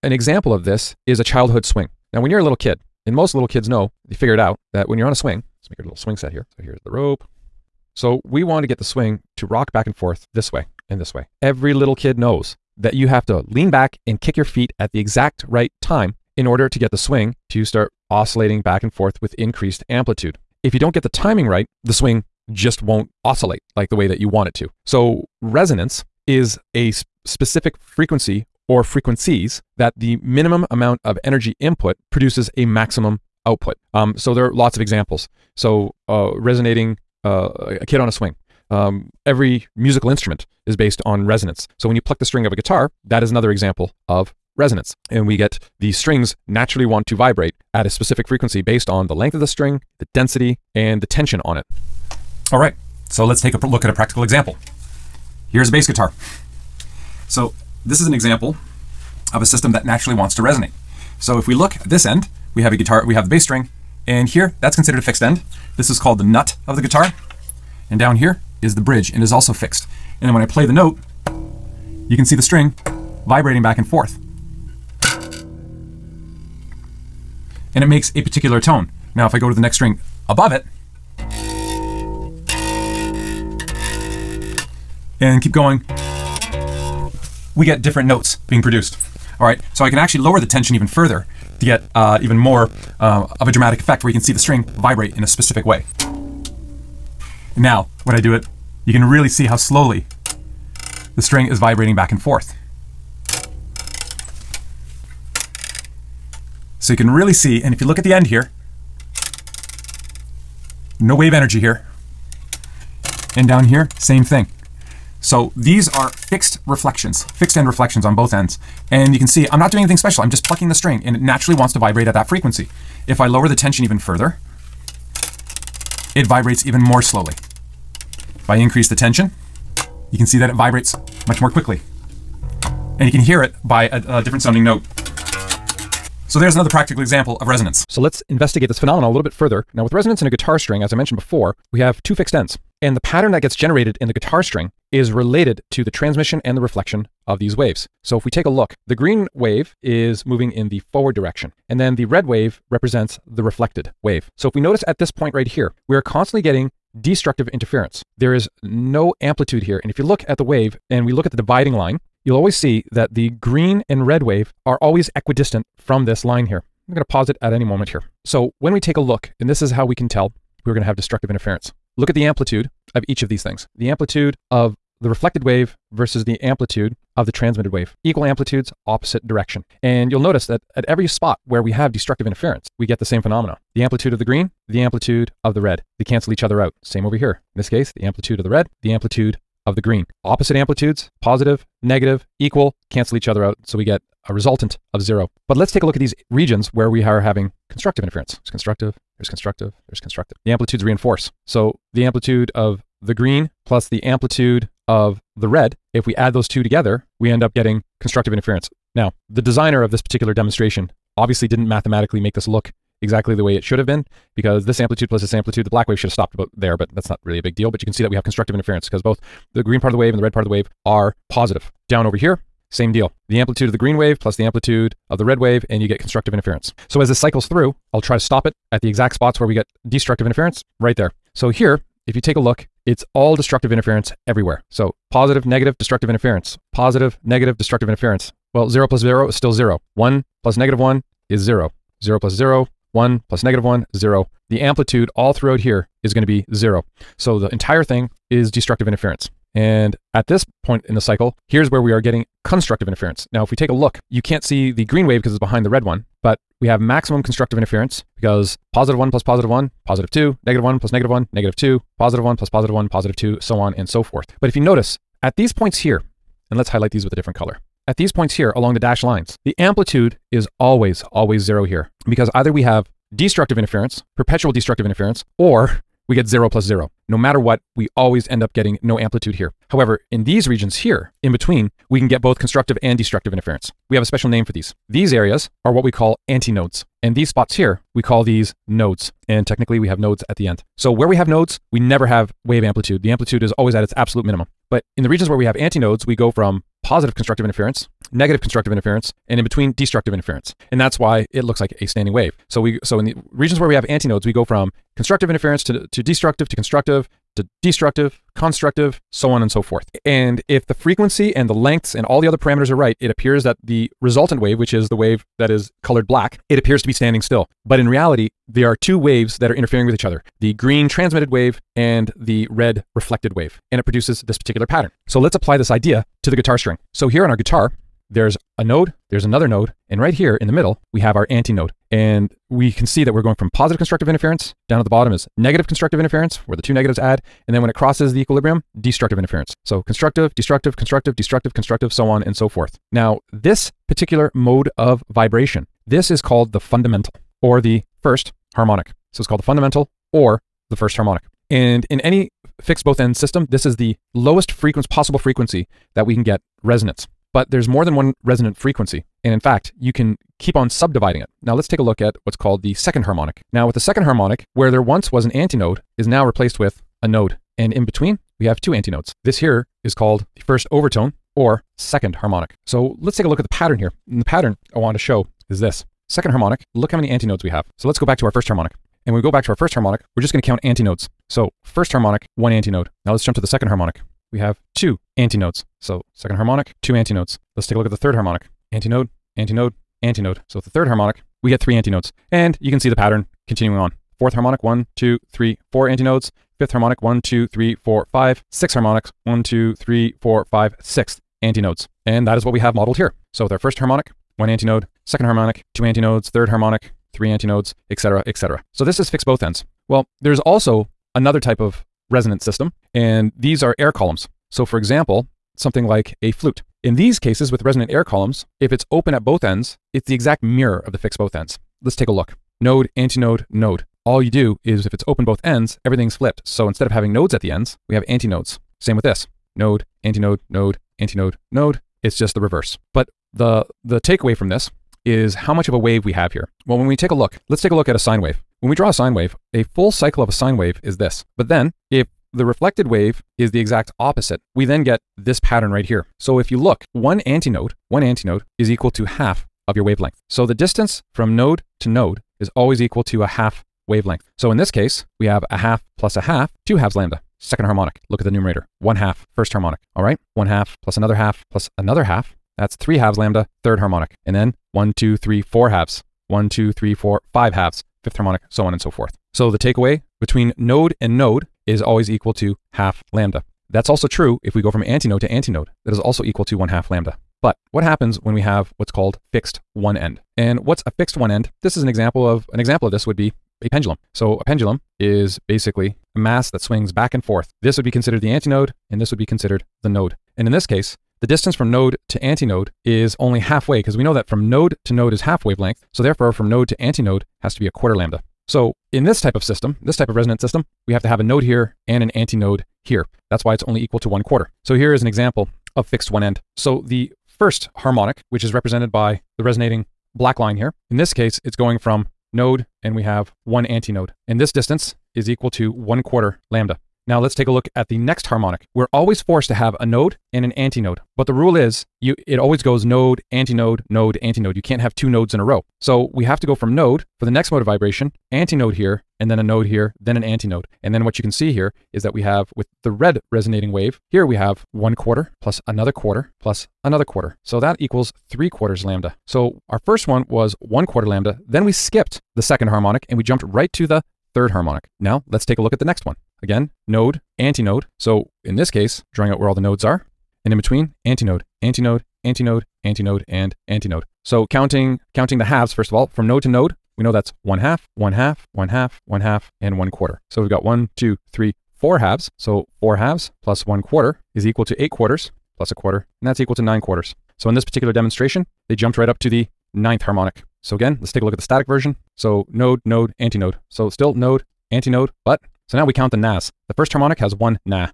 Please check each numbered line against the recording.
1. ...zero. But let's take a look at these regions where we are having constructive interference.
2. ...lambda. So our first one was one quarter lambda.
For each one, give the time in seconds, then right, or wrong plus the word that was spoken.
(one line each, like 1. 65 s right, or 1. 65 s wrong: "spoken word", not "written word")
1. 195 s right
2. 538 s right.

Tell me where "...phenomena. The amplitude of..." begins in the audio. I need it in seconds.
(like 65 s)
183 s.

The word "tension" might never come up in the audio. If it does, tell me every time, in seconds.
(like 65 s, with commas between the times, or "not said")
51 s, 90 s, 123 s, 128 s.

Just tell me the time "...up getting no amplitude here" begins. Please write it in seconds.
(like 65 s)
278 s.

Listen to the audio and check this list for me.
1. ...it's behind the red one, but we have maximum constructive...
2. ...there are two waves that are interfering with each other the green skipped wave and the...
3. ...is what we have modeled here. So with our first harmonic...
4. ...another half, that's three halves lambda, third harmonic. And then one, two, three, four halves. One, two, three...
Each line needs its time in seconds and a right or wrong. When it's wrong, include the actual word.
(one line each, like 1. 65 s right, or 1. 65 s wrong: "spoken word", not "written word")
1. 255 s right
2. 318 s wrong: "transmitted", not "skipped"
3. 402 s right
4. 461 s right.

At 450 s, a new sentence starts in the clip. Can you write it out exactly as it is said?
So the distance from node to node is always equal to a half wavelength.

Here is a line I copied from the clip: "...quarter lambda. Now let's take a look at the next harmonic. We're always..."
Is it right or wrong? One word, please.
right.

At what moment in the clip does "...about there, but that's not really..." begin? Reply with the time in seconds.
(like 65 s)
216 s.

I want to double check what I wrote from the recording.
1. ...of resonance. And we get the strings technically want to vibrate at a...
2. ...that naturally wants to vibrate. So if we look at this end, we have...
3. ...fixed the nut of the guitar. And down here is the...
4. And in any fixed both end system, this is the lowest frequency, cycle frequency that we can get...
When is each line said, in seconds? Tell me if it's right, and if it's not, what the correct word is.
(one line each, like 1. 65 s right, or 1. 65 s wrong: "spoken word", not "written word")
1. 44 s wrong: "naturally", not "technically"
2. 59 s wrong: "resonate", not "vibrate"
3. 65 s wrong: "called", not "fixed"
4. 351 s wrong: "possible", not "cycle".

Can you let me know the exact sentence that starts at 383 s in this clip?
Now let's jump to the second harmonic.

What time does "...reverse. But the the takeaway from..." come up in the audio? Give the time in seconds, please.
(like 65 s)
432 s.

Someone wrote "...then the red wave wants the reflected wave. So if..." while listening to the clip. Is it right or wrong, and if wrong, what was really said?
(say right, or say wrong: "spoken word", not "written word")
wrong: "represents", not "wants".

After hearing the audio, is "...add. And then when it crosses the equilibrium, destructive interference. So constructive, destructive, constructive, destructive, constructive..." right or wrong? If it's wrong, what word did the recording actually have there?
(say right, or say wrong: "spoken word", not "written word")
right.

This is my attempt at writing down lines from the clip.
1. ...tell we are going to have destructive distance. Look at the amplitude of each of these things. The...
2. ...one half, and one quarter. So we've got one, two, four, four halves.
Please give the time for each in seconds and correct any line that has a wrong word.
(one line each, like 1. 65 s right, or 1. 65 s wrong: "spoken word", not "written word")
1. 170 s wrong: "interference", not "distance"
2. 559 s wrong: "three", not "four".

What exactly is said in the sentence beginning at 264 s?
But if you notice, at these points here, and let's highlight these with a different color.